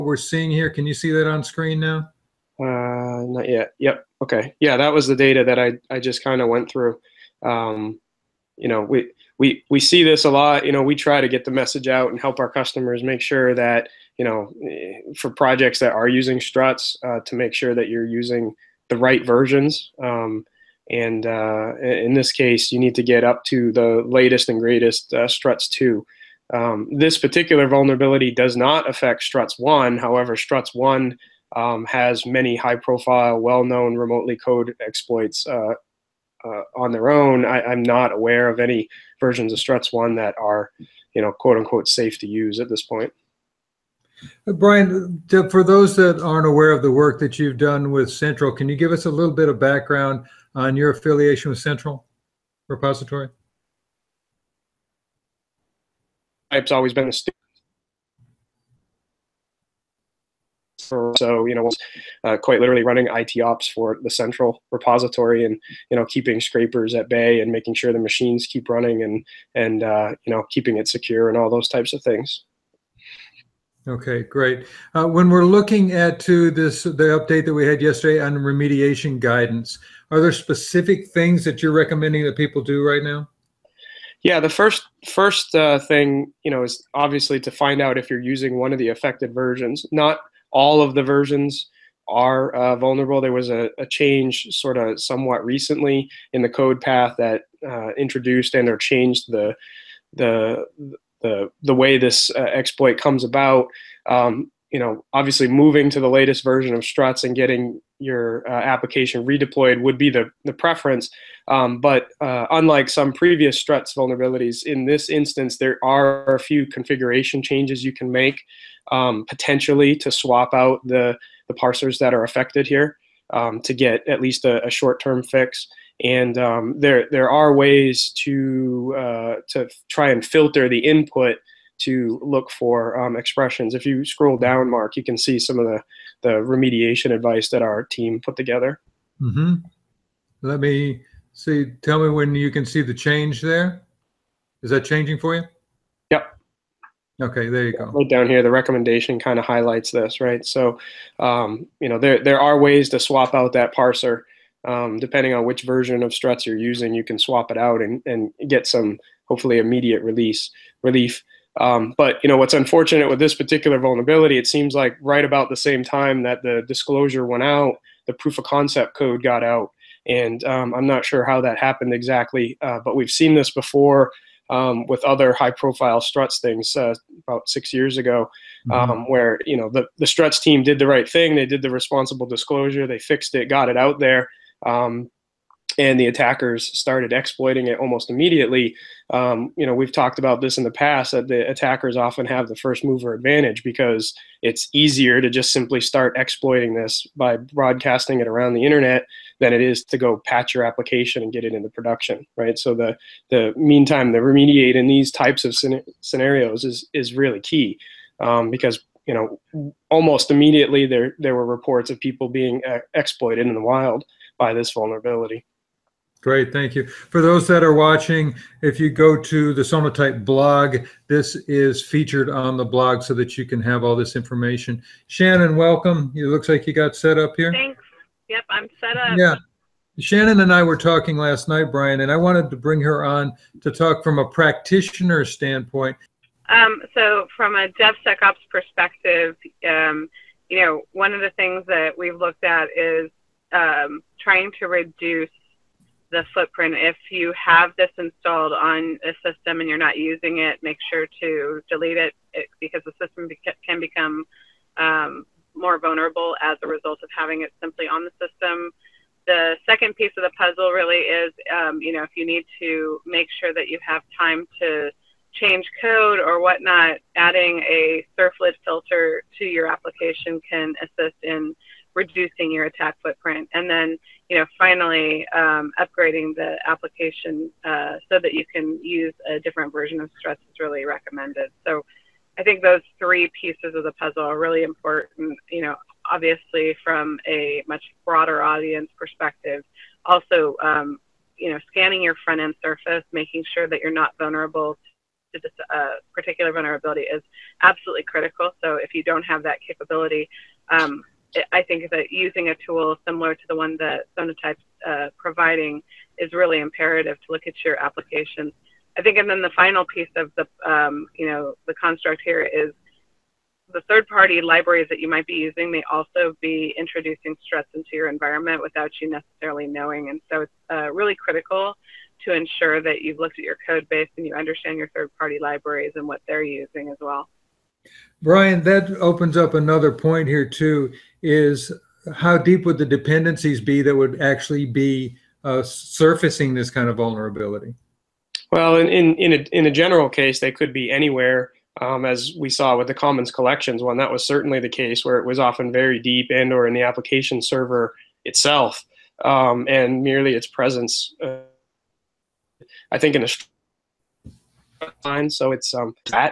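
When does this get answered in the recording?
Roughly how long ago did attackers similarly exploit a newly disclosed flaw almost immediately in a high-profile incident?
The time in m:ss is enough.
2:57.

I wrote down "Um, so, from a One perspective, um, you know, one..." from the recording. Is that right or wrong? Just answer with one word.
wrong.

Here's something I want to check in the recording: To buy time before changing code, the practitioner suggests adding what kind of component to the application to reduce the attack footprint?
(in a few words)
servlet filter.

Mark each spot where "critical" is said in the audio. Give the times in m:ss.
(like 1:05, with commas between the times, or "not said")
4:58, 5:21.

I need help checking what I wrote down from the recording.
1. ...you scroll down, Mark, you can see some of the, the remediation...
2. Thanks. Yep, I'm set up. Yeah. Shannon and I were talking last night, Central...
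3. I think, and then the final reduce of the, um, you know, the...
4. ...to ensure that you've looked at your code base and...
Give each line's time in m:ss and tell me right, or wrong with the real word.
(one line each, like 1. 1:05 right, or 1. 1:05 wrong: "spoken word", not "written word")
1. 2:13 right
2. 3:47 wrong: "Brian", not "Central"
3. 5:08 wrong: "piece", not "reduce"
4. 5:22 right.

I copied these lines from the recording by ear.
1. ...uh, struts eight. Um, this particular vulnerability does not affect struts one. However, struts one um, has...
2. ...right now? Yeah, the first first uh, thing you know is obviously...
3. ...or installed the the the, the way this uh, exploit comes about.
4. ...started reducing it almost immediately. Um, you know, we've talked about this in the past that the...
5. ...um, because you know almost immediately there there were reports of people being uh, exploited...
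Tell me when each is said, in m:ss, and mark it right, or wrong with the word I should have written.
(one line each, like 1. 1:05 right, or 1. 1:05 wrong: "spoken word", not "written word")
1. 0:25 wrong: "two", not "eight"
2. 1:22 right
3. 1:38 wrong: "changed", not "installed"
4. 3:06 wrong: "exploiting", not "reducing"
5. 3:28 right.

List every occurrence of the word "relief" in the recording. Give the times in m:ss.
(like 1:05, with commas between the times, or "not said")
2:40.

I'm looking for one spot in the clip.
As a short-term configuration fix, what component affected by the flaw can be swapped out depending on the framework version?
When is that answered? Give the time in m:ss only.
2:01.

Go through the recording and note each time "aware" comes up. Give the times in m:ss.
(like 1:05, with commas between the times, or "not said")
0:38, 0:46.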